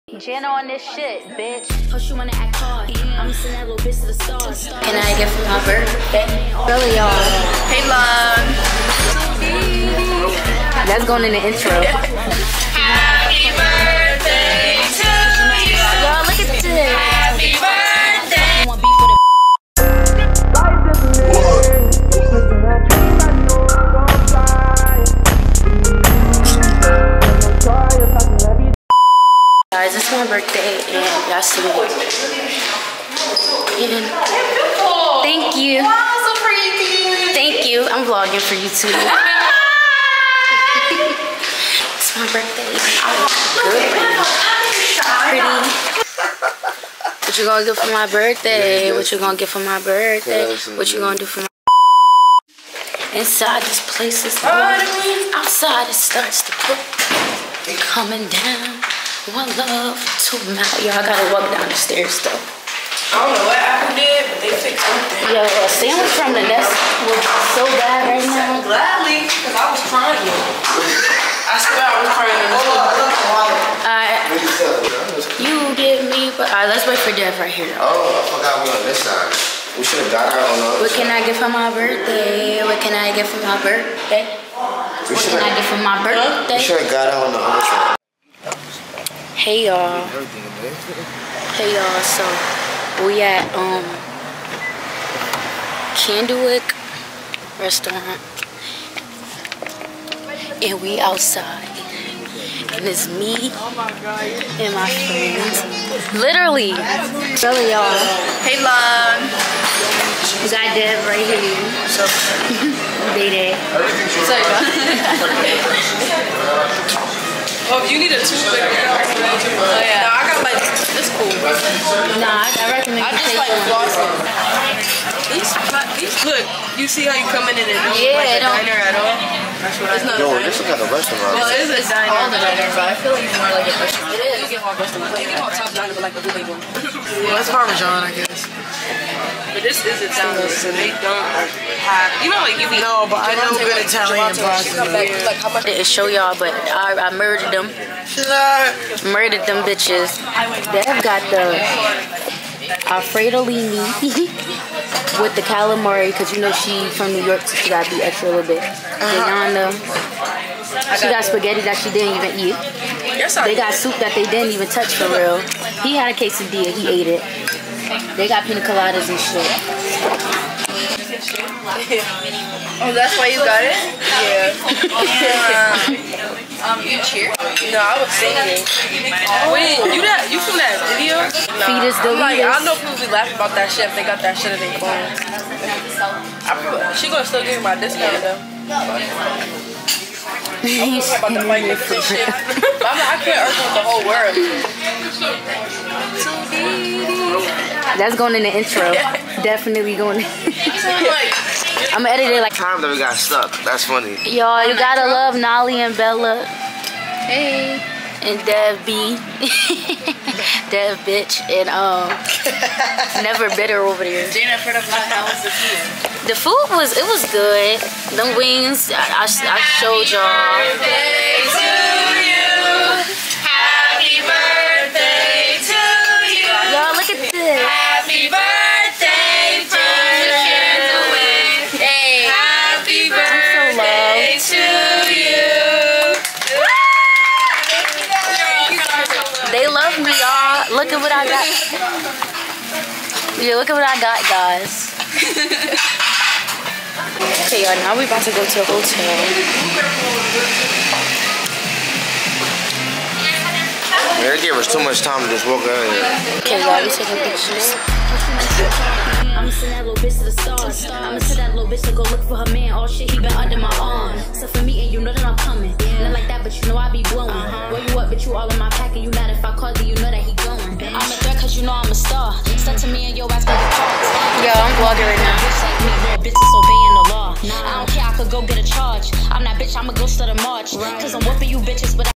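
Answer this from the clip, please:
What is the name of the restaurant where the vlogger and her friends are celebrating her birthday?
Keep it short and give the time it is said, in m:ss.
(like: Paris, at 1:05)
Candlewyck, at 1:35.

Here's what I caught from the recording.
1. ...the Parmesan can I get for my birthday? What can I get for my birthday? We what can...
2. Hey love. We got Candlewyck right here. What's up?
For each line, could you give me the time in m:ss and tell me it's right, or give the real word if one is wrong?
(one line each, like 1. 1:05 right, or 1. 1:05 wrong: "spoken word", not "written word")
1. 1:20 wrong: "What", not "Parmesan"
2. 1:48 wrong: "Deb", not "Candlewyck".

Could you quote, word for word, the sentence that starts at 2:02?
Nah, I, I reckon I just like flossing.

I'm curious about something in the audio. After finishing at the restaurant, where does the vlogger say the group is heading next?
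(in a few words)
A hotel.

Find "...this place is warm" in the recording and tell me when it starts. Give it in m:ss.
0:53.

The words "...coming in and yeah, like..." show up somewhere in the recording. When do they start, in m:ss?
2:07.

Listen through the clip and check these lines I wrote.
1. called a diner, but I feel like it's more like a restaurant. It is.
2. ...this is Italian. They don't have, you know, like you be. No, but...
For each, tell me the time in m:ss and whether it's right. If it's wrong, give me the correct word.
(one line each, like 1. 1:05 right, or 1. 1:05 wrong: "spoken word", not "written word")
1. 2:12 right
2. 2:19 right.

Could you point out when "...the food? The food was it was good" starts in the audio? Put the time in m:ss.
3:35.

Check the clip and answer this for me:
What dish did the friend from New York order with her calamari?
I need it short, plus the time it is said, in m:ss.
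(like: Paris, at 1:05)
Alfredo Lini, at 2:32.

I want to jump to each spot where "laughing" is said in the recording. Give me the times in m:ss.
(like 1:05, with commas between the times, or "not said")
3:03.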